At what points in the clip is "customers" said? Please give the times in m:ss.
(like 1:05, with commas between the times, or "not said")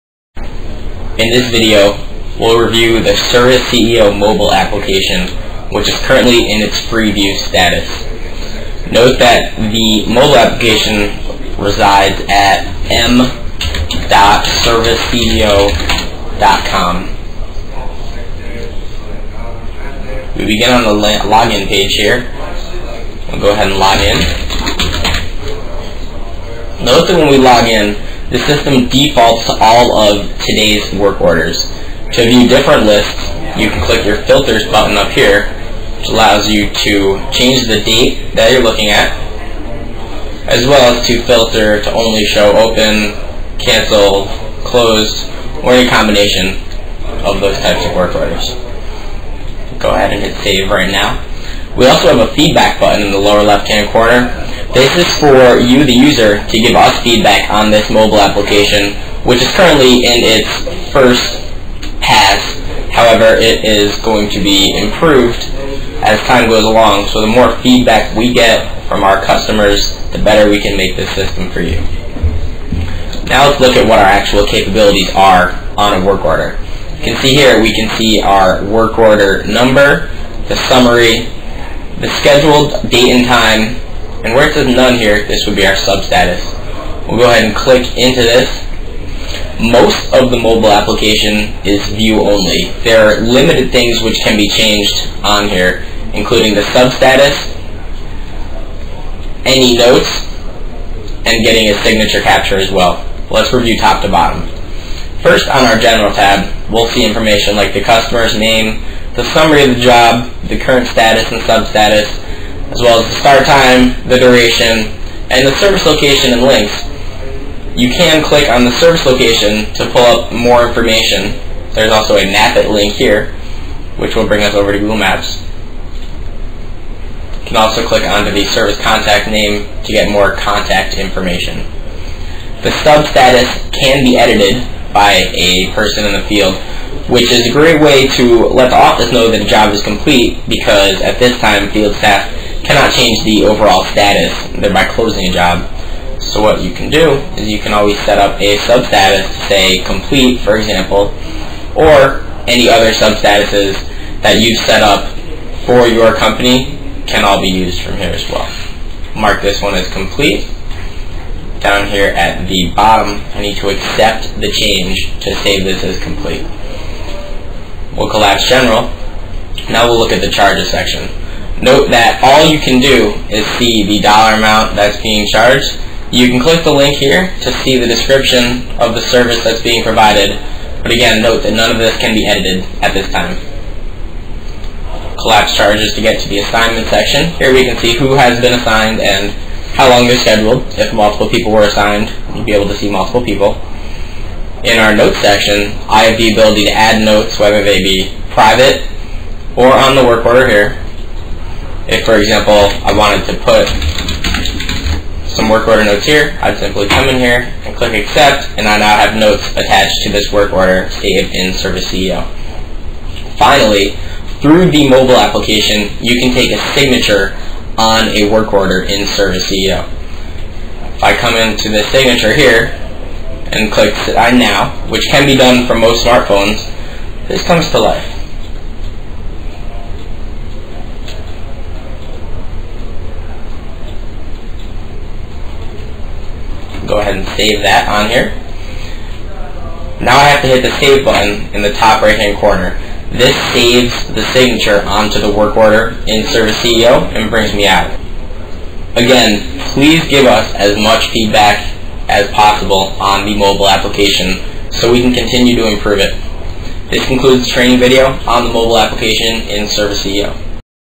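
1:09, 1:47.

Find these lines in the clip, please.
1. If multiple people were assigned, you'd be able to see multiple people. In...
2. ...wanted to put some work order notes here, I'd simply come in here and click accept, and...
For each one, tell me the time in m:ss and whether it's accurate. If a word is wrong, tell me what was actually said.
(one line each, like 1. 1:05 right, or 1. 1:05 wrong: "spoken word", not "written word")
1. 3:10 right
2. 3:22 right.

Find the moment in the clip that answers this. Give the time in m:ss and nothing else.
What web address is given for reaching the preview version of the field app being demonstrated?
0:12.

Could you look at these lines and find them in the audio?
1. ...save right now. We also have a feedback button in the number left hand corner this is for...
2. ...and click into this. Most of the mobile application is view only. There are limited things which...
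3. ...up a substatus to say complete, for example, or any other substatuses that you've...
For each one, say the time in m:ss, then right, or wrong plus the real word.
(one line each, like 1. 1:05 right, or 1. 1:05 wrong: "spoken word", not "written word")
1. 0:50 wrong: "lower", not "number"
2. 1:27 right
3. 2:28 right.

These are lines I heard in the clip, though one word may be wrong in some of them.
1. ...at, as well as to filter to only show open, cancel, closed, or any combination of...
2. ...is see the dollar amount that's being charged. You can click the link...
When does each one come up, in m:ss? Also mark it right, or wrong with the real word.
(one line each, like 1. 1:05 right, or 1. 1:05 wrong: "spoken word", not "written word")
1. 0:38 right
2. 2:53 right.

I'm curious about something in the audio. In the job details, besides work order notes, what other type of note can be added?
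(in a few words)
private.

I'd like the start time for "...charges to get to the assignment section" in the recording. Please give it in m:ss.
3:05.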